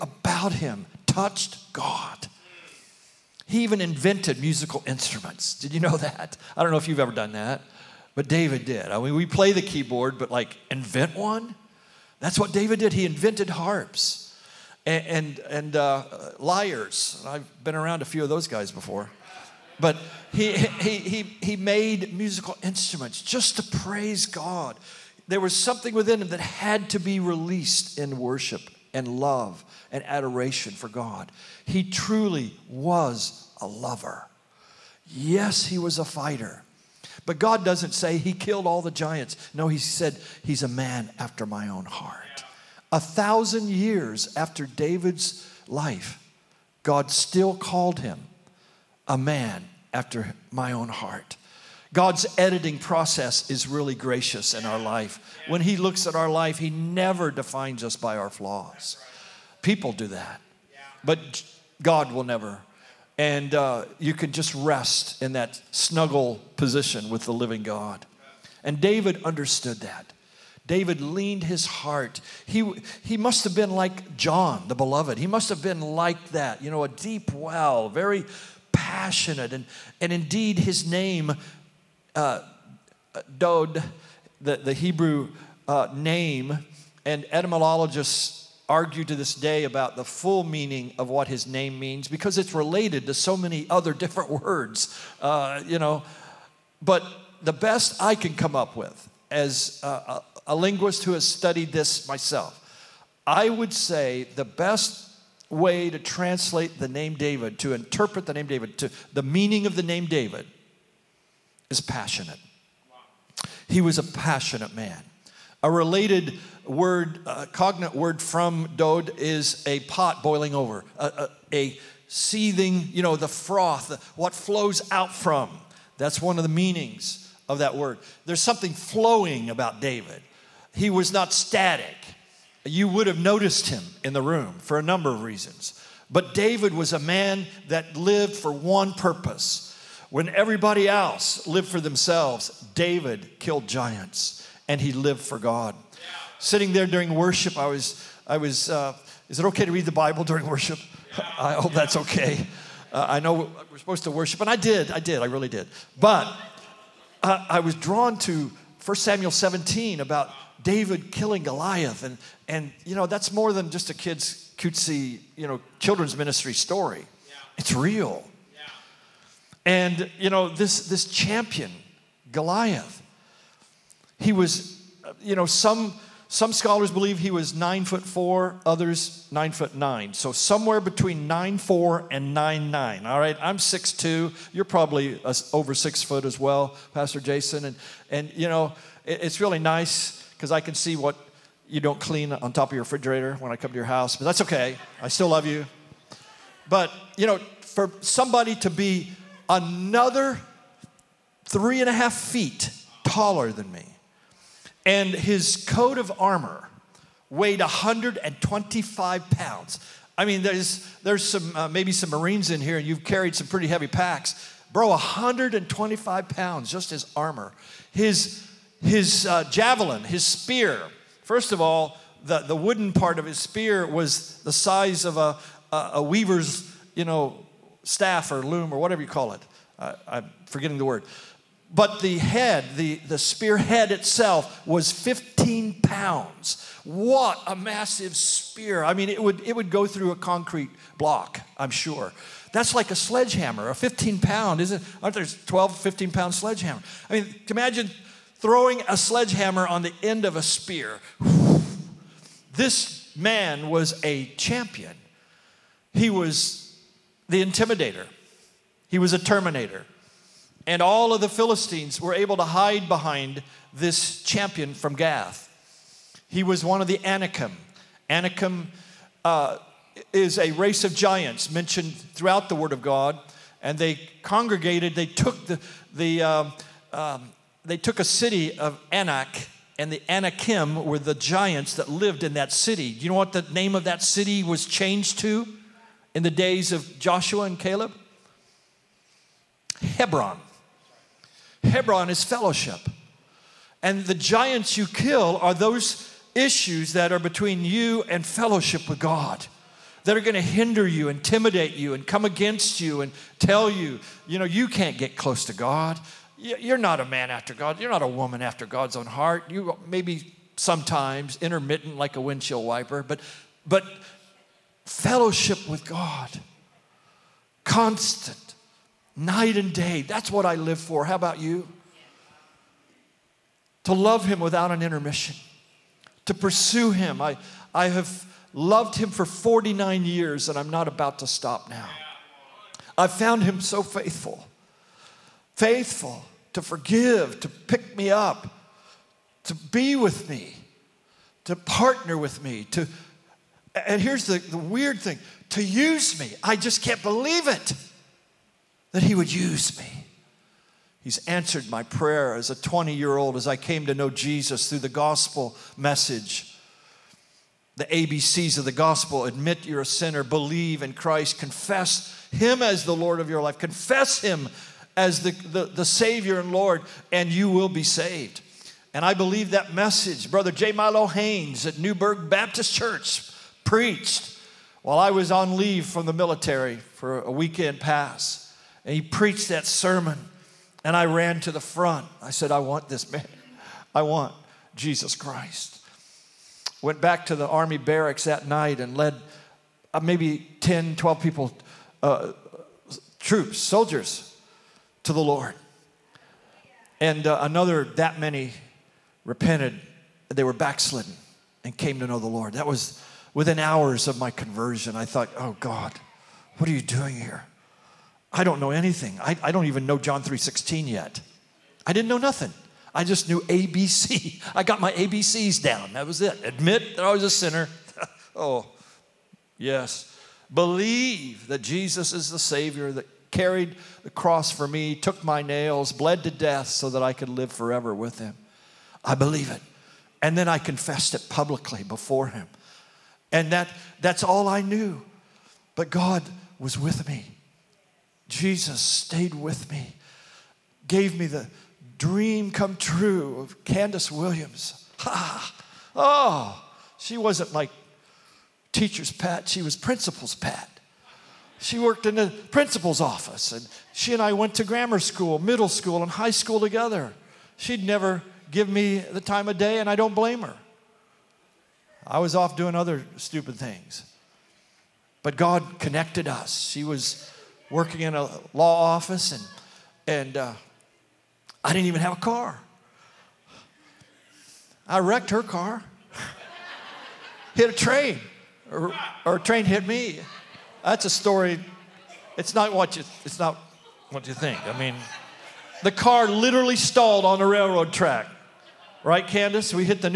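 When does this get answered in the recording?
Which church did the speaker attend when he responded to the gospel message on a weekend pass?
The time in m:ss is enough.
6:11.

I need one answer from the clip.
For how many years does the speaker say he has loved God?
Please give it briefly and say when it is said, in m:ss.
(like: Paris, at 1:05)
49 years, at 5:29.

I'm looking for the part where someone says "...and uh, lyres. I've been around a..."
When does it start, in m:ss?
0:15.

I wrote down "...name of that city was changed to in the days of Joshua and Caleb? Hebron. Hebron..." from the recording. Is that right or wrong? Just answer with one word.
right.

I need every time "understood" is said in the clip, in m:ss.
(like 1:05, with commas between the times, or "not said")
1:09.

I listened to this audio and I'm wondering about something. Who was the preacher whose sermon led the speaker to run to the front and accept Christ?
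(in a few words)
J. Milo Haynes.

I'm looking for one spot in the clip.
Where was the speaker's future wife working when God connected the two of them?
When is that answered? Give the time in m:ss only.
7:48.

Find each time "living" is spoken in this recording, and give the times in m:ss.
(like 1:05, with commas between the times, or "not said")
1:07.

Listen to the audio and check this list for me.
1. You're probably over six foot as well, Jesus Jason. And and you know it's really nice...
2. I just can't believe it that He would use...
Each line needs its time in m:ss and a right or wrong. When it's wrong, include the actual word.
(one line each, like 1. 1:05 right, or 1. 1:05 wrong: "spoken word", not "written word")
1. 3:04 wrong: "Pastor", not "Jesus"
2. 5:46 right.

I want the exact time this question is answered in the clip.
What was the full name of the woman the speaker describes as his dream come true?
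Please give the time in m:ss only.
7:23.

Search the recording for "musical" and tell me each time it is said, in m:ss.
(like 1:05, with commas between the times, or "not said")
0:04, 0:22.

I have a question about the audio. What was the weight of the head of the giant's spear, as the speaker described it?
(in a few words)
15 pounds.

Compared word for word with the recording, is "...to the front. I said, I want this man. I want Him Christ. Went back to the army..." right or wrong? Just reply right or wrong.
wrong.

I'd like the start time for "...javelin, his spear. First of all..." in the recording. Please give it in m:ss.
3:39.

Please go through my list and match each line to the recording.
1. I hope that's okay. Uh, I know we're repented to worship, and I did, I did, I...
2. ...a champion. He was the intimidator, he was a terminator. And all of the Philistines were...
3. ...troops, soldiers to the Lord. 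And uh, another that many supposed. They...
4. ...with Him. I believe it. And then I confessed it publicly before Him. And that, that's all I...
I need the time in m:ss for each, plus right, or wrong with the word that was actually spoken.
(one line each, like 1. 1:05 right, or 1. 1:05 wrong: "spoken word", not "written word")
1. 2:31 wrong: "supposed", not "repented"
2. 4:14 right
3. 6:33 wrong: "repented", not "supposed"
4. 7:07 right.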